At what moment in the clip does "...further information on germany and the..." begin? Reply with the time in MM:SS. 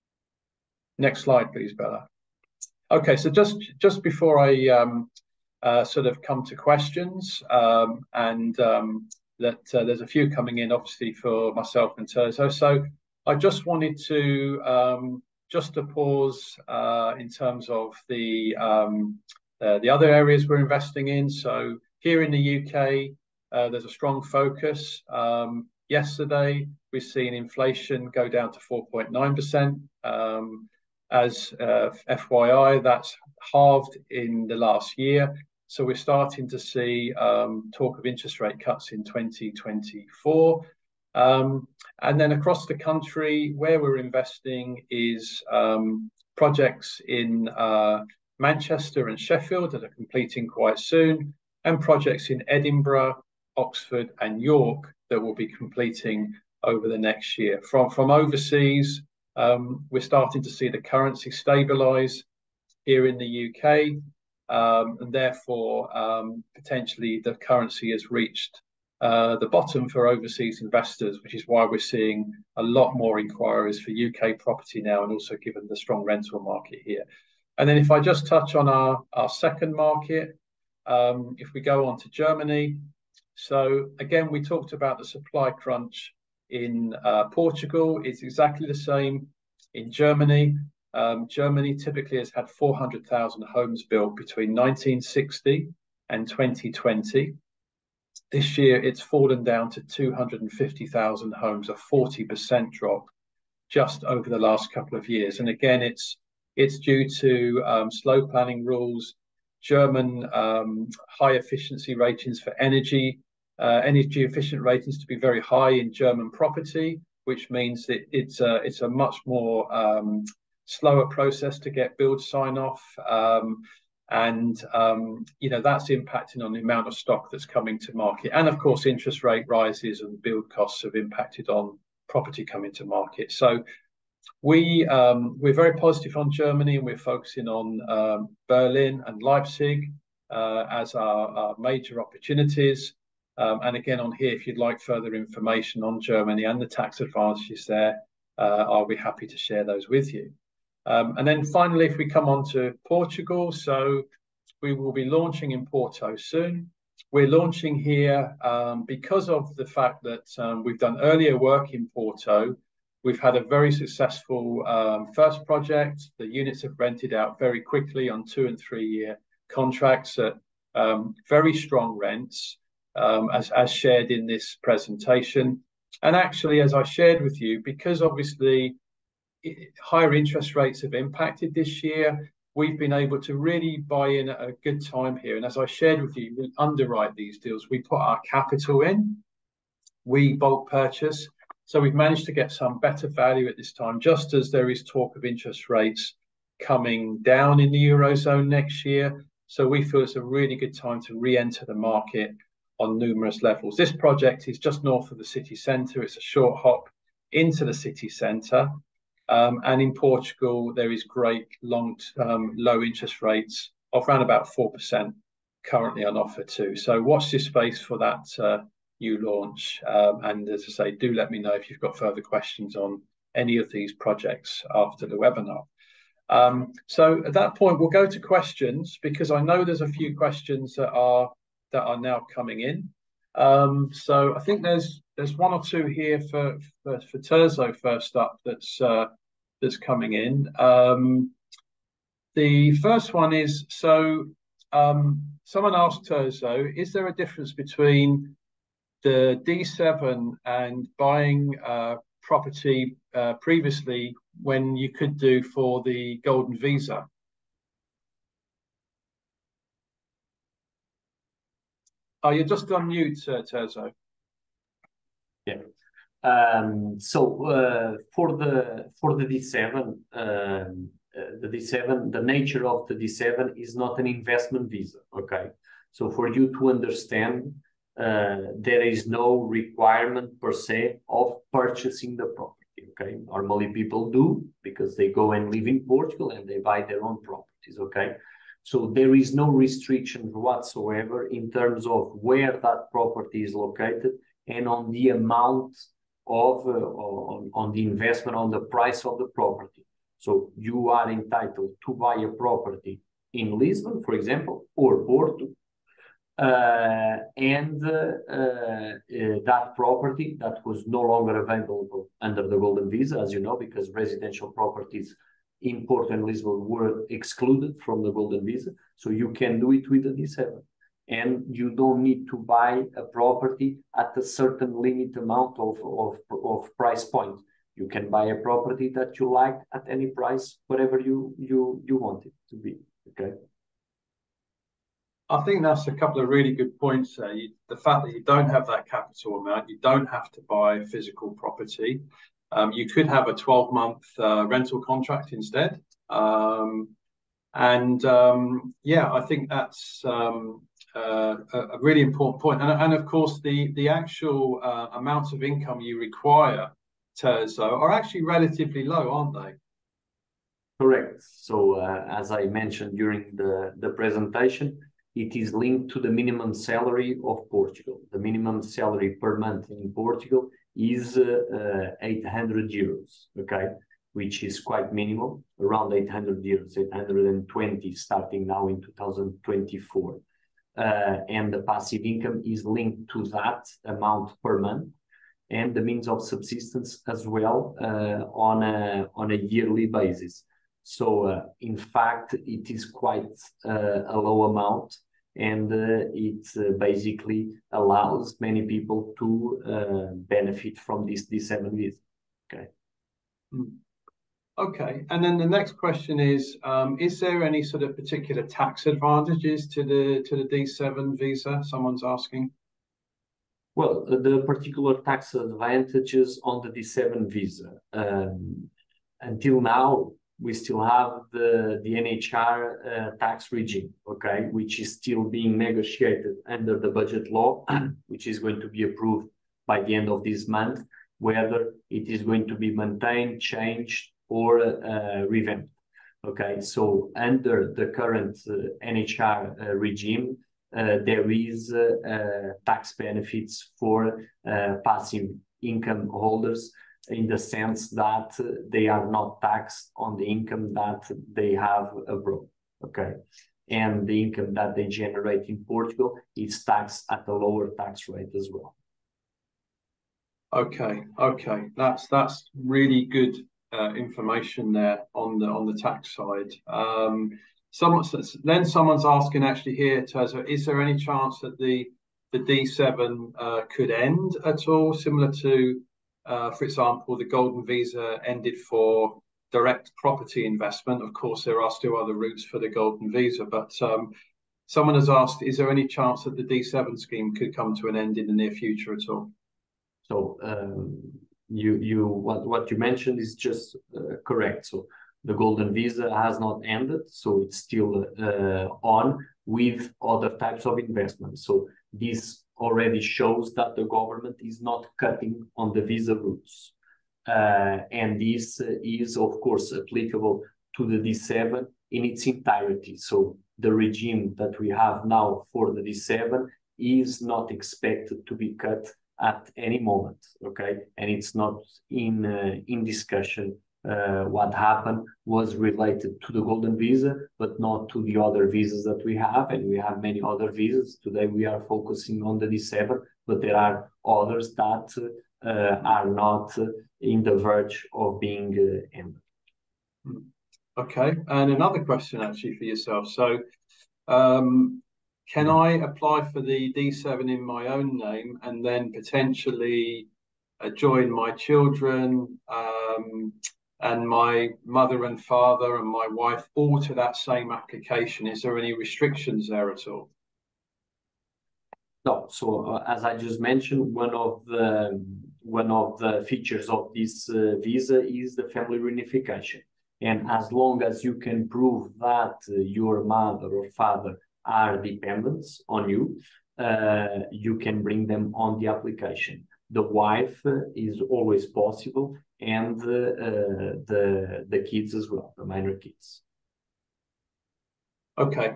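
02:24.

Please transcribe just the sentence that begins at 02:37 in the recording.
We're launching here um, because of the fact that um, we've done earlier work in Porto.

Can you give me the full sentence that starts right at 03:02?
We've been able to really buy in at a good time here.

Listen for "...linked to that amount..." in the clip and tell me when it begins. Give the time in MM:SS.
06:22.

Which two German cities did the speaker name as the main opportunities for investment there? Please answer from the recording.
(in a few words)
Berlin and Leipzig.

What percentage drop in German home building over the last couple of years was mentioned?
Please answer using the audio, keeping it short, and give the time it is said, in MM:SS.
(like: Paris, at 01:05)
40%, at 01:41.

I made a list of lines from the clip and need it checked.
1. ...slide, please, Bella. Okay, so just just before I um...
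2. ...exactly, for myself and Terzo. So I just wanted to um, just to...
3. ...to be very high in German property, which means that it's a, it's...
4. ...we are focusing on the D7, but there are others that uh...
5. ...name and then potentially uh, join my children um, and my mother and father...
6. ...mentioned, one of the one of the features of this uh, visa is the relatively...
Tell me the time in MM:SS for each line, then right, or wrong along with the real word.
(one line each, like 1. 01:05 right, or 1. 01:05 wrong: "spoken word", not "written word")
1. 00:01 right
2. 00:10 wrong: "obviously", not "exactly"
3. 01:54 right
4. 08:51 right
5. 09:07 right
6. 09:23 wrong: "family", not "relatively".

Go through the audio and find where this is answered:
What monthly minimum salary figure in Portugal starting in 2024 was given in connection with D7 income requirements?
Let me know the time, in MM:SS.
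06:16.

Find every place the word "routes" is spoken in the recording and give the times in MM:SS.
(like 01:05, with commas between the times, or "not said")
08:02, 08:26.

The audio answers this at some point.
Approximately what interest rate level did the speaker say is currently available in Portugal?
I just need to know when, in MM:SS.
03:34.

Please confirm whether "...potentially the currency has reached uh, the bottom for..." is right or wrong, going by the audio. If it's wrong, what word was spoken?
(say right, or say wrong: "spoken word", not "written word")
right.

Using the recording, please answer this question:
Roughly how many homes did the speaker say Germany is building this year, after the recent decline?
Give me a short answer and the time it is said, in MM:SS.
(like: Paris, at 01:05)
250,000, at 01:39.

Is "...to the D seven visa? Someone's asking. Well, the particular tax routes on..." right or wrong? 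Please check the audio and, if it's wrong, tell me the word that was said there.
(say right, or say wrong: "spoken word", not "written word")
wrong: "advantages", not "routes".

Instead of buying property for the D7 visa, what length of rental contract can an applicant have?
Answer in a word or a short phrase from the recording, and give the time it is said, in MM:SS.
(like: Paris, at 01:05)
12 months, at 05:43.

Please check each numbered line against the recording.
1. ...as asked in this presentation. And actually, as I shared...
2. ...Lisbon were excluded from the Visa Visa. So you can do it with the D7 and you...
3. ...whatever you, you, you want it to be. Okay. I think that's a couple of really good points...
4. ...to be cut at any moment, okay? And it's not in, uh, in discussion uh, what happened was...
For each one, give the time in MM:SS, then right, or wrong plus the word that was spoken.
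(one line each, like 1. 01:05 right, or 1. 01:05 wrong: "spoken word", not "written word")
1. 02:53 wrong: "shared", not "asked"
2. 05:16 wrong: "Golden", not "Visa"
3. 05:30 right
4. 08:38 right.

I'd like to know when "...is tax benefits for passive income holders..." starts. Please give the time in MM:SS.
07:21.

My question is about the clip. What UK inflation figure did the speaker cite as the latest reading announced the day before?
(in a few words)
4.9%.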